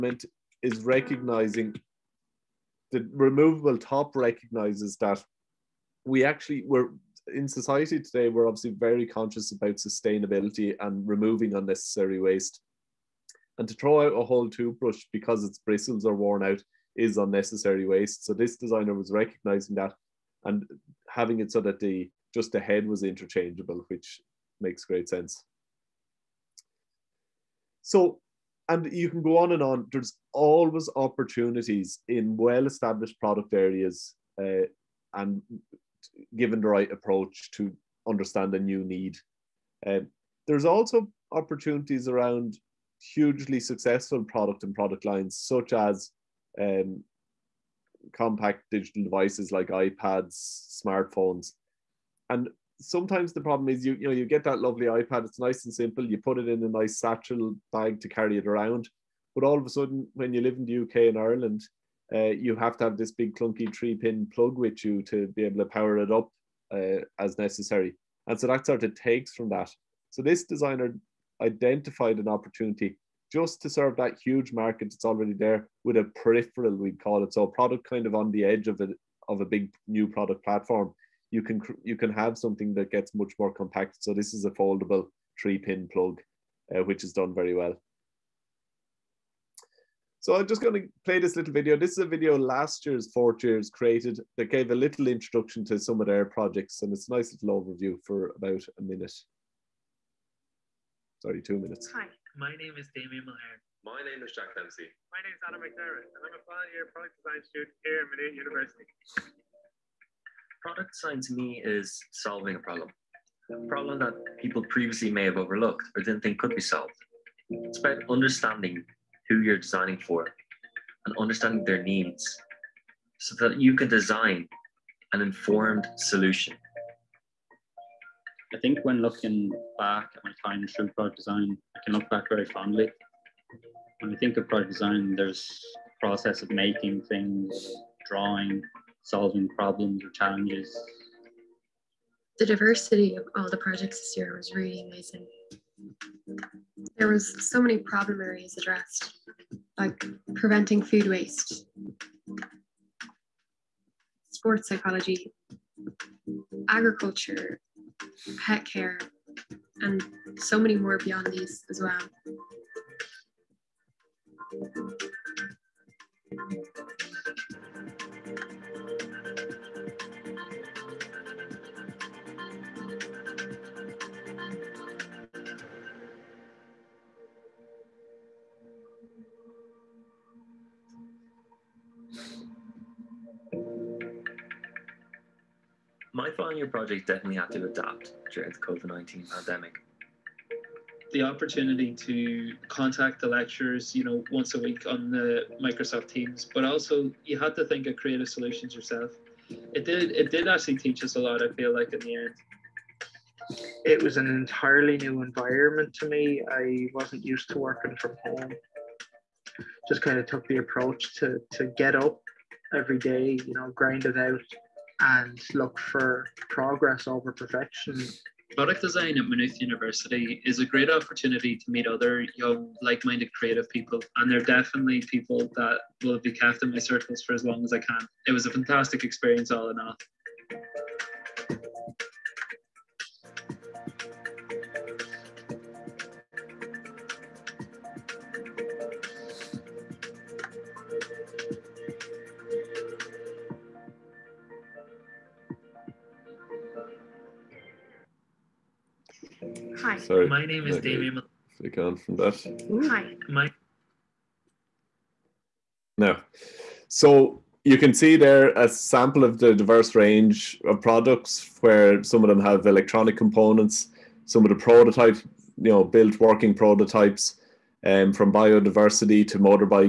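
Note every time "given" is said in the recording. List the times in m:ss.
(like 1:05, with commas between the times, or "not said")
0:36.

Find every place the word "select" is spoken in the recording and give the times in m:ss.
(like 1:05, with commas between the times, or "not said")
not said.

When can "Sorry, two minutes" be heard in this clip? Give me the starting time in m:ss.
1:41.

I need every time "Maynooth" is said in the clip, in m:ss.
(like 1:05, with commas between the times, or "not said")
1:48, 3:39.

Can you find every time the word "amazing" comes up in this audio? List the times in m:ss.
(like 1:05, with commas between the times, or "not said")
2:24.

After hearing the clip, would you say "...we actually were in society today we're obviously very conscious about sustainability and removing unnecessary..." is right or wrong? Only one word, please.
right.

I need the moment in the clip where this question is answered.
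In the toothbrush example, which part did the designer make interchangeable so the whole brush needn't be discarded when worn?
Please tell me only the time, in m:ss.
0:22.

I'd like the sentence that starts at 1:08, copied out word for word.
And so that sort of takes from that.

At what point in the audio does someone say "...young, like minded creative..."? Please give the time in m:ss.
3:42.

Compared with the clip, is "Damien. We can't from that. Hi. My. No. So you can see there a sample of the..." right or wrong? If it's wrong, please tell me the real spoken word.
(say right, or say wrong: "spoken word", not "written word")
right.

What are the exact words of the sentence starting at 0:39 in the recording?
Um, there's also opportunities around hugely successful product and product lines, such as um, compact digital devices like iPads, smartphones.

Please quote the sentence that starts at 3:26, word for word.
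I wasn't used to working from home.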